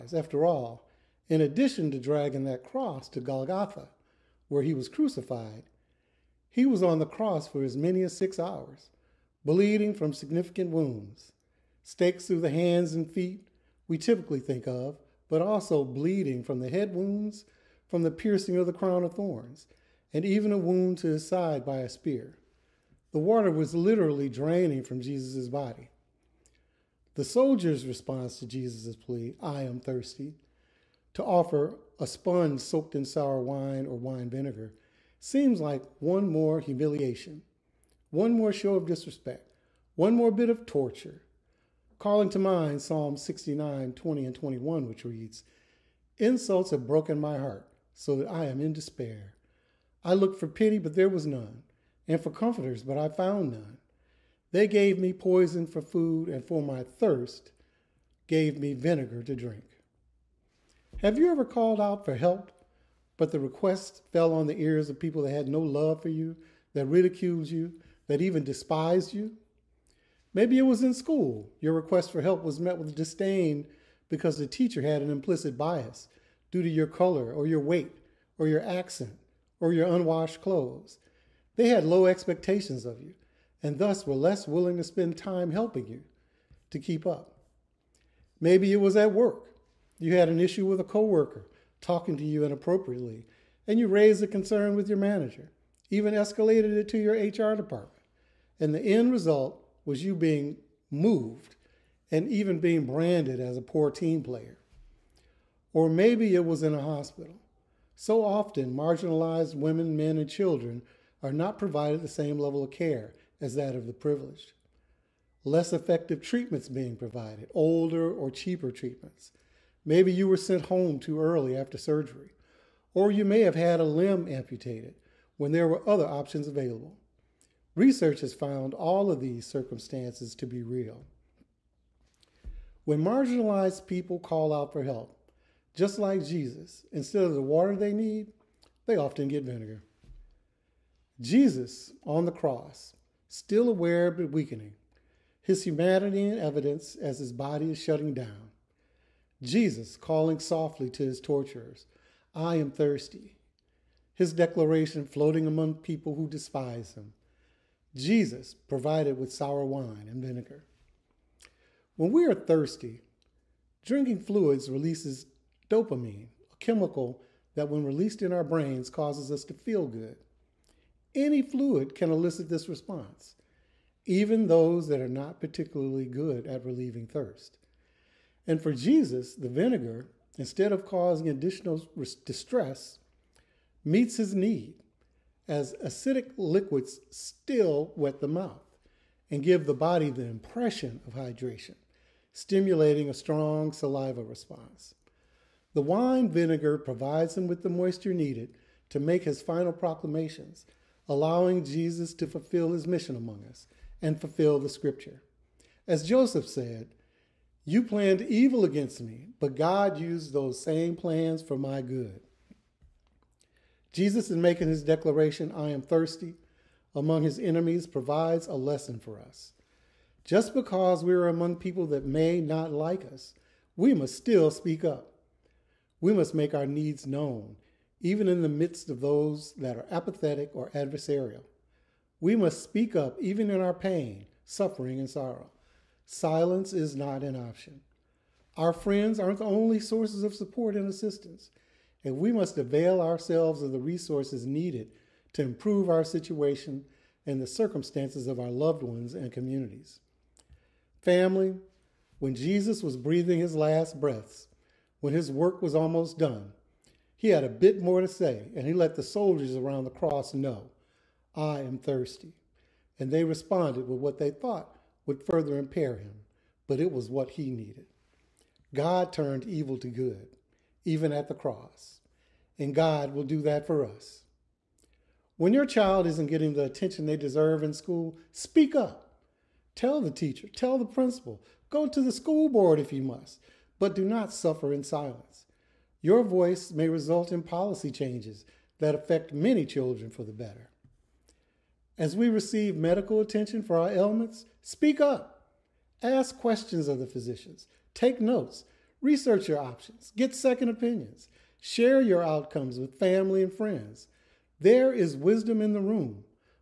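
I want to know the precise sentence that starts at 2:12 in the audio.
When marginalized people call out for help, just like Jesus, instead of the water they need, they often get vinegar.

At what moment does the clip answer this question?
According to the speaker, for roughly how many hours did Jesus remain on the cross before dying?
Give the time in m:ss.
0:08.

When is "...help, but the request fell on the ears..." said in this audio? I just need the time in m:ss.
1:02.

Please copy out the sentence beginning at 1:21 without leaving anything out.
They had low expectations of you and thus were less willing to spend time helping you to keep up.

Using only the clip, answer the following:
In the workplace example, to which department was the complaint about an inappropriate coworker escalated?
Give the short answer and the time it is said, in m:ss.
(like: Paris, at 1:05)
HR, at 1:37.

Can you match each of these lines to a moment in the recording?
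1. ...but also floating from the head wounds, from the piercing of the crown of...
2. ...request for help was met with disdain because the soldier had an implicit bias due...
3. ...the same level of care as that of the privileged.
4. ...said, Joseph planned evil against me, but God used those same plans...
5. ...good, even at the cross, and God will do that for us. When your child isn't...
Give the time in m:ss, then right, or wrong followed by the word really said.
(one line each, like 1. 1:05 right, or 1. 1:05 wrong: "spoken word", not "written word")
1. 0:15 wrong: "bleeding", not "floating"
2. 1:11 wrong: "teacher", not "soldier"
3. 1:52 right
4. 3:26 wrong: "You", not "Joseph"
5. 4:29 right.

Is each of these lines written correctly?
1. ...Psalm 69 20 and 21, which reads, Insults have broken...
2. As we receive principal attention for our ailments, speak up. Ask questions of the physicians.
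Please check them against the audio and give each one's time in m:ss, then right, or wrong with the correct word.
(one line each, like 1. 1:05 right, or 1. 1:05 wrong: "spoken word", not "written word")
1. 0:42 right
2. 4:51 wrong: "medical", not "principal".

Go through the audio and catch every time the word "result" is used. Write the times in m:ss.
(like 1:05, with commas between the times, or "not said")
1:39, 4:46.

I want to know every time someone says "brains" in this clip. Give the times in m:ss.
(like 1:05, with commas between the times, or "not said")
2:48.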